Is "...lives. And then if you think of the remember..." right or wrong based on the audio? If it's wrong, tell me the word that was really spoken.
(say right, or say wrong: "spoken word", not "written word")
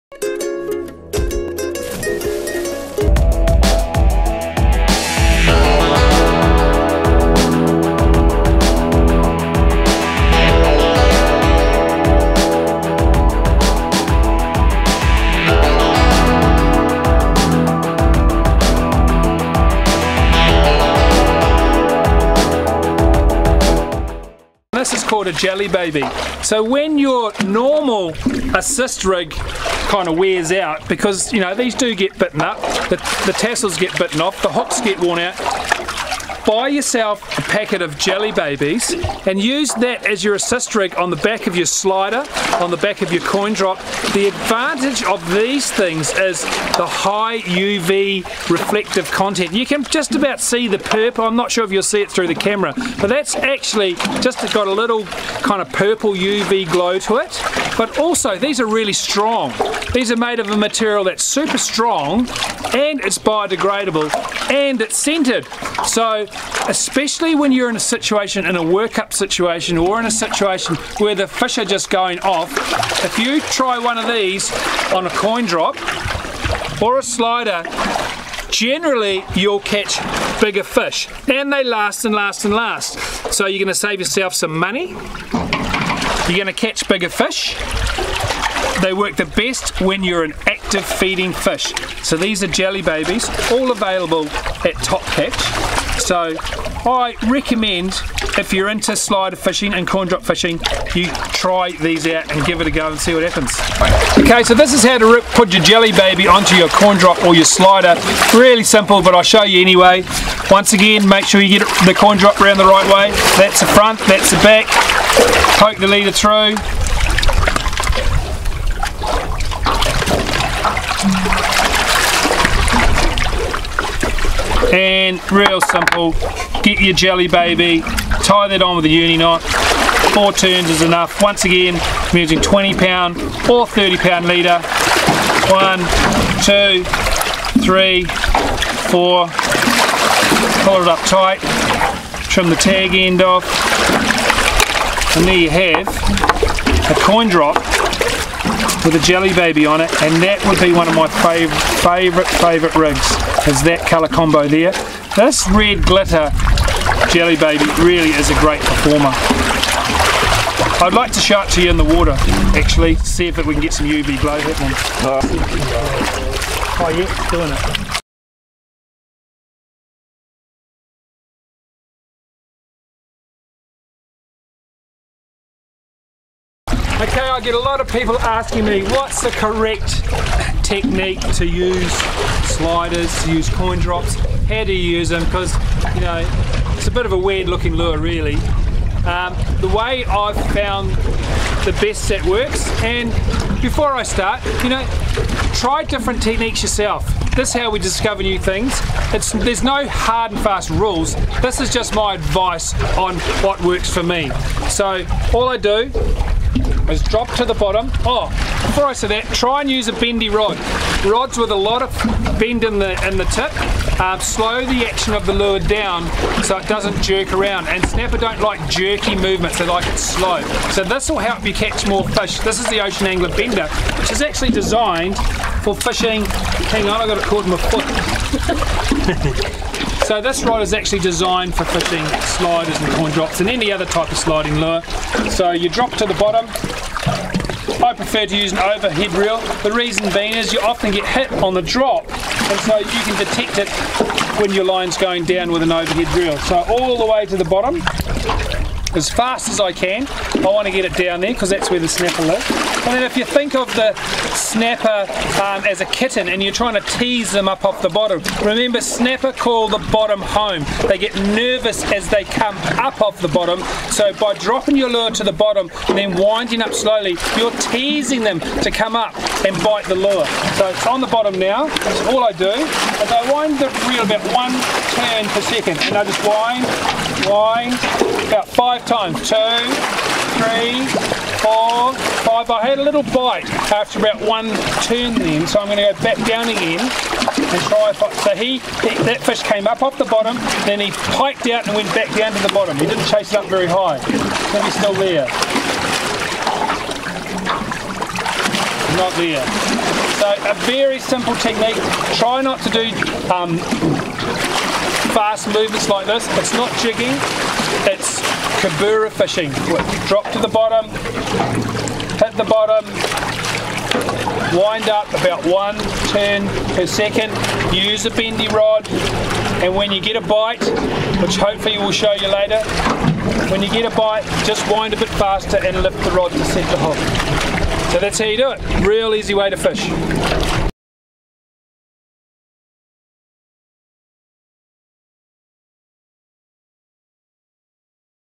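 wrong: "snapper", not "remember".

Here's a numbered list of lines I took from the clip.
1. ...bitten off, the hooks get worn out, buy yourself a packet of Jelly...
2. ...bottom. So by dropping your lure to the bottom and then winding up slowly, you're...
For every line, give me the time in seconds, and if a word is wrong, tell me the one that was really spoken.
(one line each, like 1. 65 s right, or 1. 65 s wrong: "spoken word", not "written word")
1. 33 s right
2. 263 s right.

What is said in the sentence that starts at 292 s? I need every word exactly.
He didn't chase it up very high.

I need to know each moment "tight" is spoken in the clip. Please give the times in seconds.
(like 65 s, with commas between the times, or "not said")
141 s.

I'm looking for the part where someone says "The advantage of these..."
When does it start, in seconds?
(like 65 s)
44 s.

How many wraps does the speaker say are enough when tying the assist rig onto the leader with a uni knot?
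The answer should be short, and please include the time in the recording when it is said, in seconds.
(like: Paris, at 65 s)
4, at 130 s.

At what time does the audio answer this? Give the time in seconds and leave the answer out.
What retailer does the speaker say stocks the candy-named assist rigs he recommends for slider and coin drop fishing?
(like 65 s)
94 s.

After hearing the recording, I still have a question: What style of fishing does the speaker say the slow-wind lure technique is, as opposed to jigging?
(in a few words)
Kabura fishing.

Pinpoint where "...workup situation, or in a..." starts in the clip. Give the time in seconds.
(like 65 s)
68 s.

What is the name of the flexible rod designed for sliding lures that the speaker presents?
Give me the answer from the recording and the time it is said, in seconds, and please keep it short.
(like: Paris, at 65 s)
Ocean Angler Bender, at 222 s.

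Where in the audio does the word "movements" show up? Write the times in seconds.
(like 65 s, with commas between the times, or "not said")
219 s, 305 s.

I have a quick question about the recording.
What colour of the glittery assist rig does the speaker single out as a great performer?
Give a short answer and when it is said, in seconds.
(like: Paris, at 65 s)
Red glitter, at 155 s.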